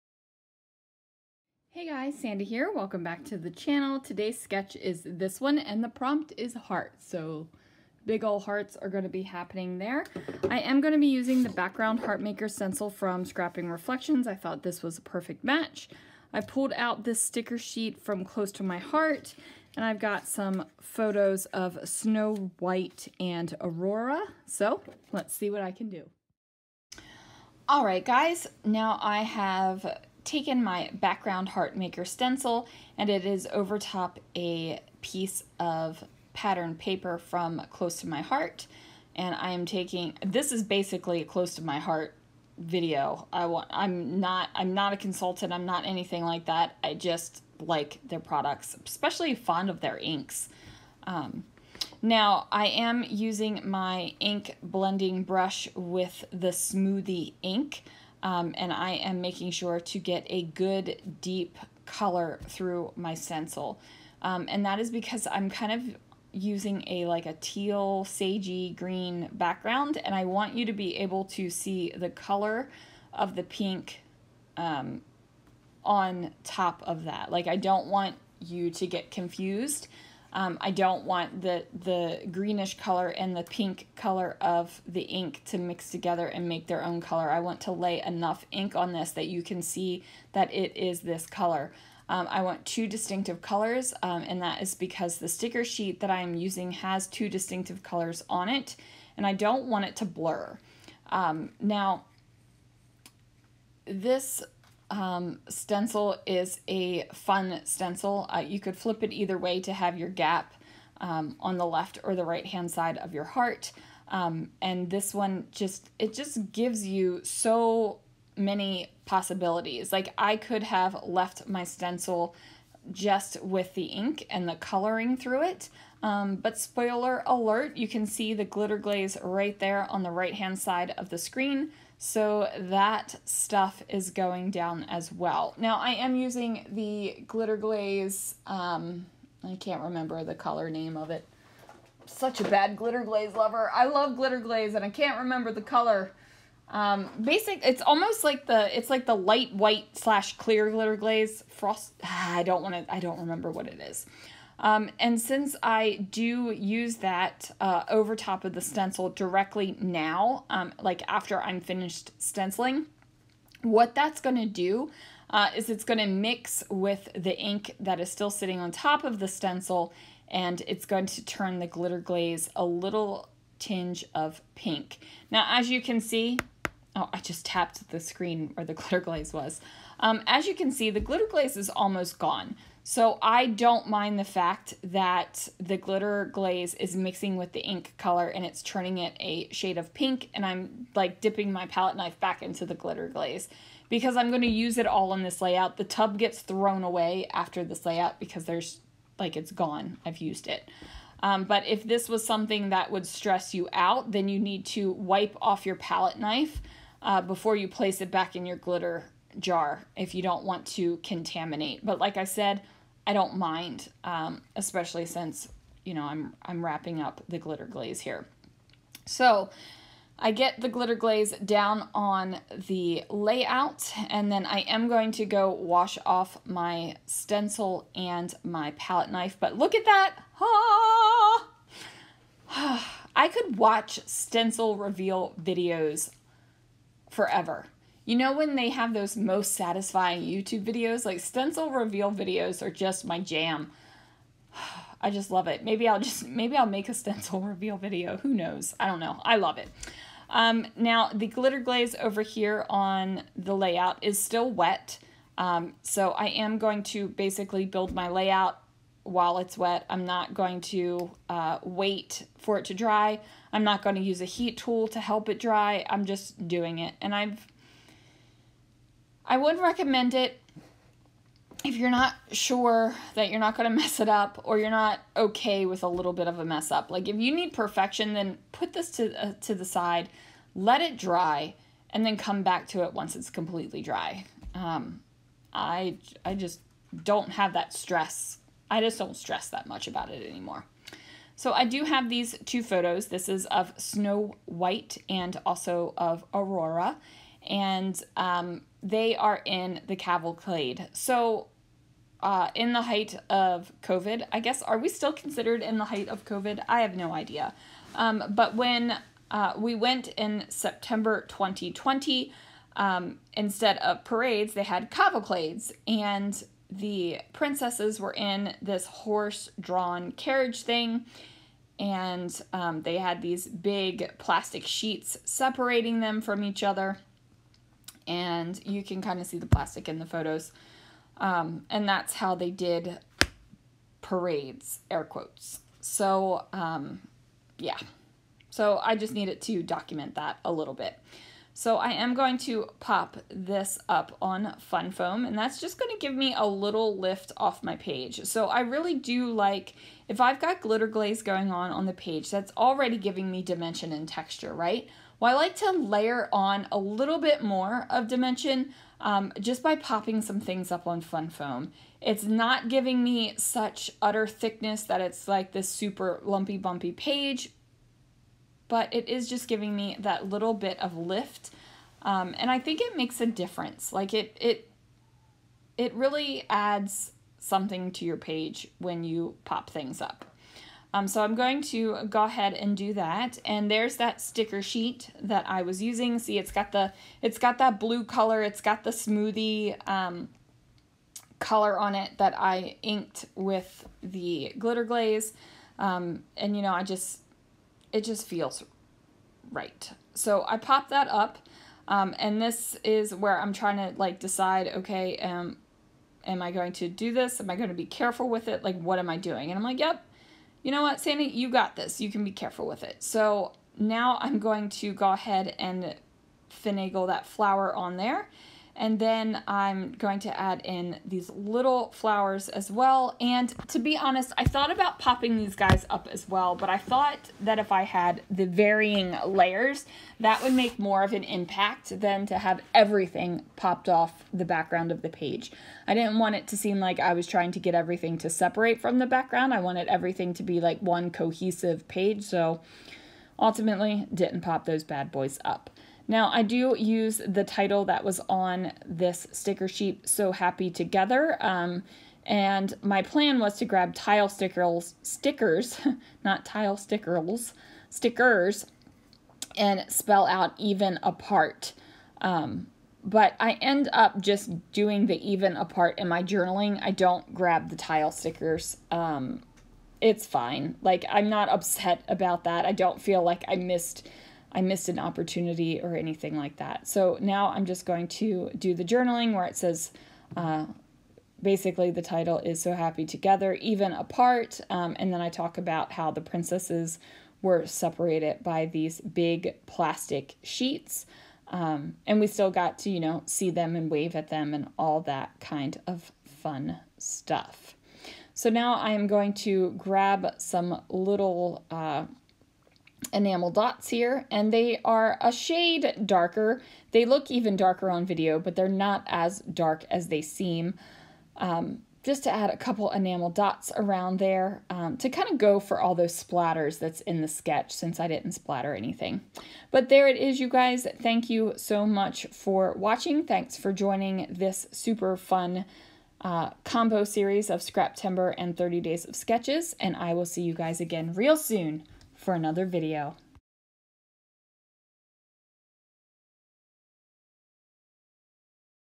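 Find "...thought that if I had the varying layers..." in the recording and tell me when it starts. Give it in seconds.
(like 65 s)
426 s.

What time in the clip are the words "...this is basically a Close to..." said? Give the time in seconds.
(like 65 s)
40 s.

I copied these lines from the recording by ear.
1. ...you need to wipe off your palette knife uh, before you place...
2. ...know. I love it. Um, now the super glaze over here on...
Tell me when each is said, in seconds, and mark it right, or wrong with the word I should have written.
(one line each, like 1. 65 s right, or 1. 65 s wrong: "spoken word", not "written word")
1. 204 s right
2. 248 s wrong: "glitter", not "super".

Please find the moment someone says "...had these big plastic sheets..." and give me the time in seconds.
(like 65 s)
322 s.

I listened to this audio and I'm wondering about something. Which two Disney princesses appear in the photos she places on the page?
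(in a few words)
Snow White and Aurora.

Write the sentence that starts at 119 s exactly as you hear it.
Like I could have left my stencil just with the ink and the coloring through it.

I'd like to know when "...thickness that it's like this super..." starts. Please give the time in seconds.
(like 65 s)
364 s.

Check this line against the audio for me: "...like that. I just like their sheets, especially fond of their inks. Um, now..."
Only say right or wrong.
wrong.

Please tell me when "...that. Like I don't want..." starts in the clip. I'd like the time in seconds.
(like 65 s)
77 s.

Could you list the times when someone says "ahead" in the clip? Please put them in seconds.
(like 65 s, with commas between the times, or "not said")
382 s, 415 s.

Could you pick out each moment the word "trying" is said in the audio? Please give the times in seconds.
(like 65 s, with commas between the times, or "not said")
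403 s, 437 s.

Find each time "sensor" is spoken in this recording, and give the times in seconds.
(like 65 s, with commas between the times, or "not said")
not said.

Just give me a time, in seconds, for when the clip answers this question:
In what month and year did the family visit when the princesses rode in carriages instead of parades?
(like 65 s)
310 s.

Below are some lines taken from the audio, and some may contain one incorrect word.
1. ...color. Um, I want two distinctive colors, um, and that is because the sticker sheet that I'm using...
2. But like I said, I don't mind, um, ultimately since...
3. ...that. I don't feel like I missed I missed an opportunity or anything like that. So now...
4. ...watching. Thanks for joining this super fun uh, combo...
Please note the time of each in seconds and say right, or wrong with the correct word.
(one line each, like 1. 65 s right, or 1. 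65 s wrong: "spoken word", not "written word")
1. 91 s right
2. 211 s wrong: "especially", not "ultimately"
3. 472 s right
4. 522 s right.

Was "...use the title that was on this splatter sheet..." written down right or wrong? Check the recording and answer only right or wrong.
wrong.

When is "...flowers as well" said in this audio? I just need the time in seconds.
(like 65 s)
421 s.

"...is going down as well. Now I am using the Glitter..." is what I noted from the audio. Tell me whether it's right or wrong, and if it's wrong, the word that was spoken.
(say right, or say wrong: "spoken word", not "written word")
right.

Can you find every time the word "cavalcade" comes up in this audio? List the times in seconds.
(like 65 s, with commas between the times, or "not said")
299 s, 314 s.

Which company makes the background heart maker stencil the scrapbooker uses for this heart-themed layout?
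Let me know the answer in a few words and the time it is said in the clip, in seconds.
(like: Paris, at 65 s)
Scrapping Reflections, at 13 s.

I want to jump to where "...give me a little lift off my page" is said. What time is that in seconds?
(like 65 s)
345 s.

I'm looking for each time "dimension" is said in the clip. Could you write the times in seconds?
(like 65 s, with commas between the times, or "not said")
353 s, 358 s.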